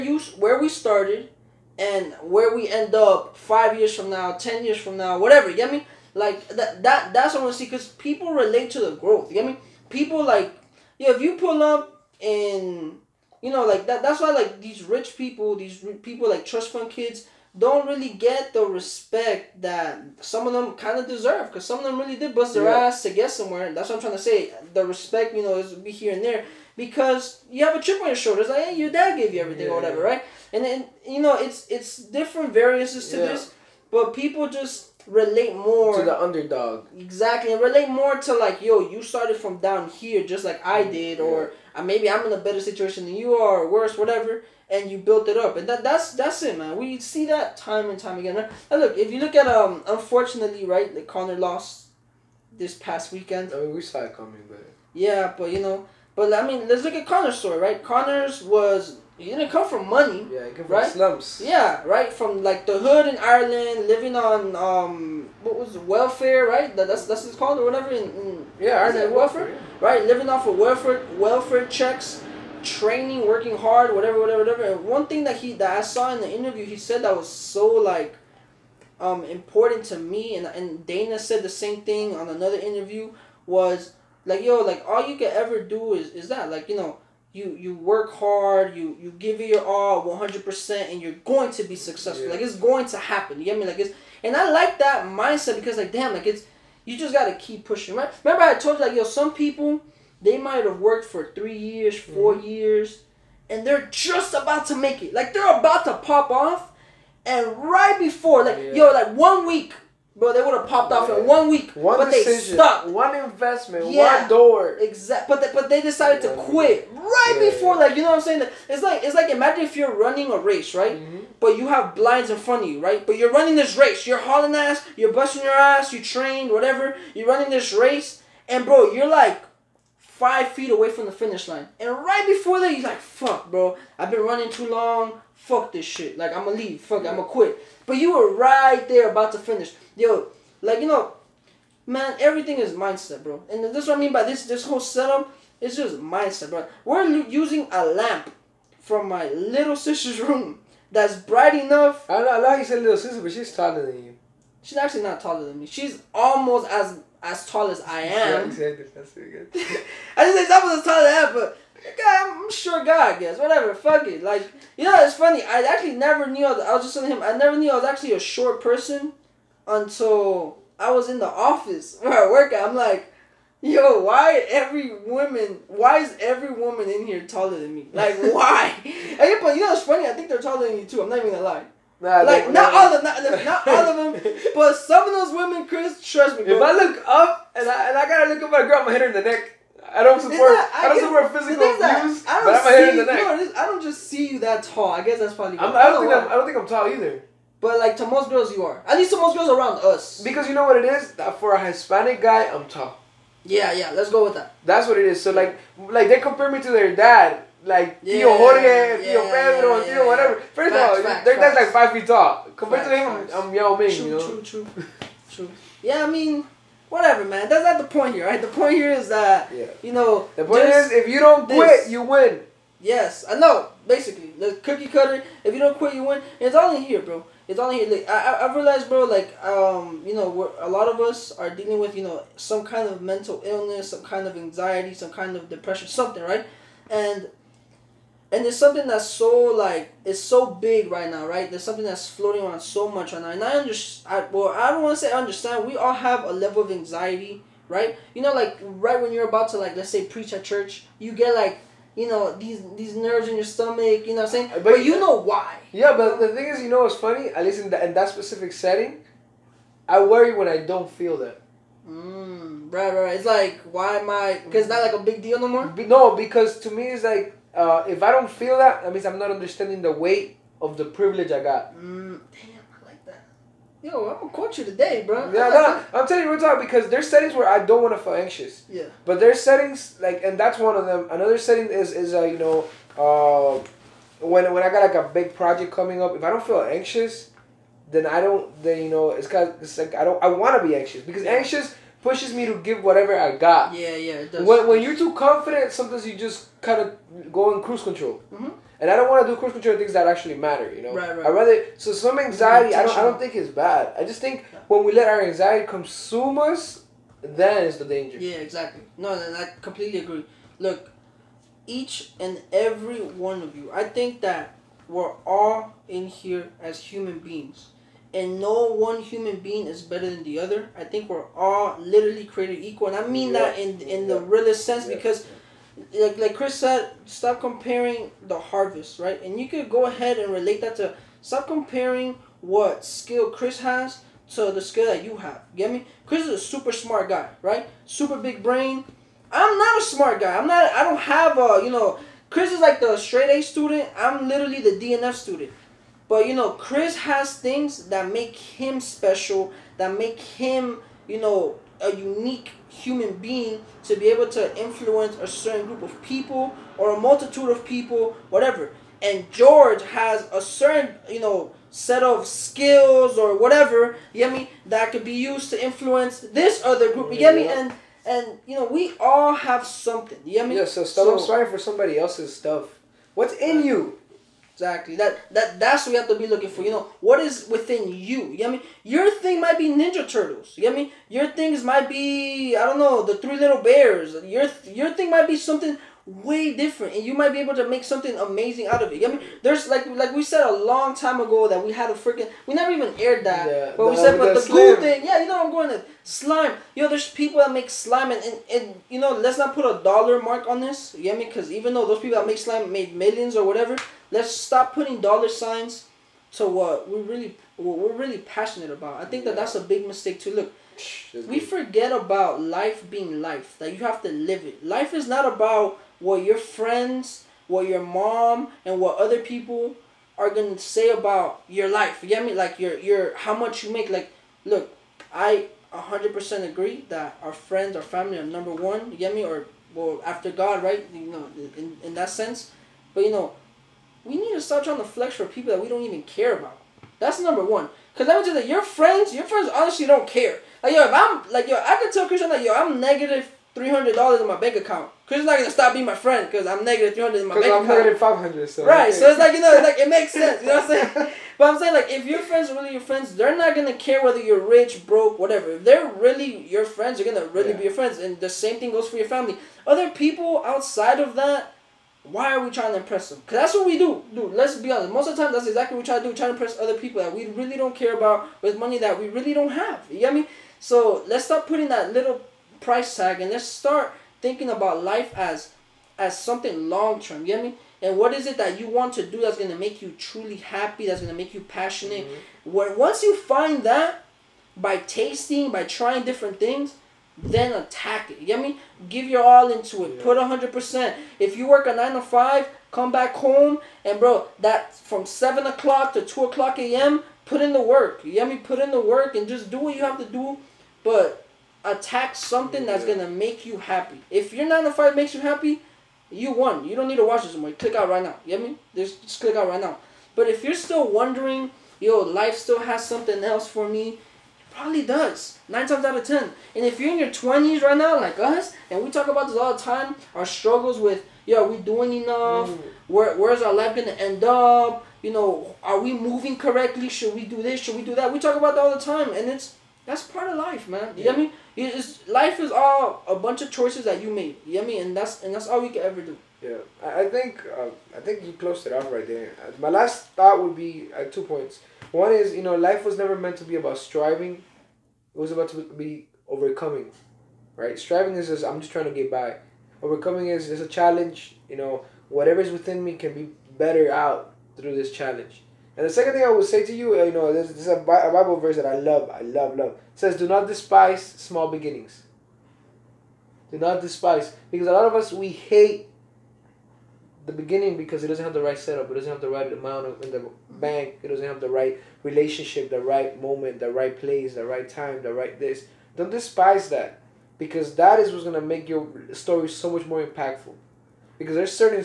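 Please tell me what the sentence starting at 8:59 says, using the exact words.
Uh, my last thought would be uh, two points.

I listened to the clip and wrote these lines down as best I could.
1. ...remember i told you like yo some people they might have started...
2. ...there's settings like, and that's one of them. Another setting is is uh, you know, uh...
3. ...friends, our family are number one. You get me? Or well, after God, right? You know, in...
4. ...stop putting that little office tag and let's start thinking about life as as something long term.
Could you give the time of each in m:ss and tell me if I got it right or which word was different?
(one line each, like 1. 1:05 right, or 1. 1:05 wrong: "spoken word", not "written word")
1. 1:38 wrong: "worked", not "started"
2. 4:39 right
3. 7:07 right
4. 7:51 wrong: "price", not "office".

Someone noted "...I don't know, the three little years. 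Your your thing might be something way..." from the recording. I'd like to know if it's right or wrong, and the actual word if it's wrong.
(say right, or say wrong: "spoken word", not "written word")
wrong: "bears", not "years".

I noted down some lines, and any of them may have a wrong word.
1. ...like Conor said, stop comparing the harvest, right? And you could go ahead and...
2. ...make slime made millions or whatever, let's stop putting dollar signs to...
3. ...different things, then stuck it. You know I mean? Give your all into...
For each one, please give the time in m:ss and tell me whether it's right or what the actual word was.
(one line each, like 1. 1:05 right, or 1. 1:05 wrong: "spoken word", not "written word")
1. 5:26 wrong: "Chris", not "Conor"
2. 6:42 right
3. 8:06 wrong: "attack", not "stuck".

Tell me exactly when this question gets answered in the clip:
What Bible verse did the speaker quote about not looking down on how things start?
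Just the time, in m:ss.
9:20.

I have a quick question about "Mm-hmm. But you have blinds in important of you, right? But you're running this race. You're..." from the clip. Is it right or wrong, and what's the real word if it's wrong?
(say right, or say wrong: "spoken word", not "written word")
wrong: "front", not "important".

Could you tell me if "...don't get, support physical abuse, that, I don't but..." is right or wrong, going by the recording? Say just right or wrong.
right.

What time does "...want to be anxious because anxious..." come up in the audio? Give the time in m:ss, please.
4:50.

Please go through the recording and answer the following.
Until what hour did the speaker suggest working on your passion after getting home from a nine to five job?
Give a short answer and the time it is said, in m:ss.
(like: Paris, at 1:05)
2 a.m., at 8:16.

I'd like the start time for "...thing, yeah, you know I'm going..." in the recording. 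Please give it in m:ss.
6:34.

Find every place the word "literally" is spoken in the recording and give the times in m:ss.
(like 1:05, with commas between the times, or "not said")
5:21, 5:44.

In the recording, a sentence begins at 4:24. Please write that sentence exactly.
Because it's not like a big deal no more.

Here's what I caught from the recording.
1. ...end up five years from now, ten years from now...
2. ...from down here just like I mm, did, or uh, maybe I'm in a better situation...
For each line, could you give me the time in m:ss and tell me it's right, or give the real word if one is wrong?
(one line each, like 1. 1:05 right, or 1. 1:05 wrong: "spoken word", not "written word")
1. 0:02 right
2. 0:39 right.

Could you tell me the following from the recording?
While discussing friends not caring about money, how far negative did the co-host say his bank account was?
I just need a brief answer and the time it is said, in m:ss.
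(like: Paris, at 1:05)
-$500, at 7:27.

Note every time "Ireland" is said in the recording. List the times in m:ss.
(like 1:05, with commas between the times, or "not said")
1:03, 1:08.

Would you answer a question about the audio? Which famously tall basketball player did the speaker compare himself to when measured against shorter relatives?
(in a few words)
Yao Ming.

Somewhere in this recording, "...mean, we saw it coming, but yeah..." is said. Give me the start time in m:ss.
0:53.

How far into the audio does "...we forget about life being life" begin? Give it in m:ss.
6:51.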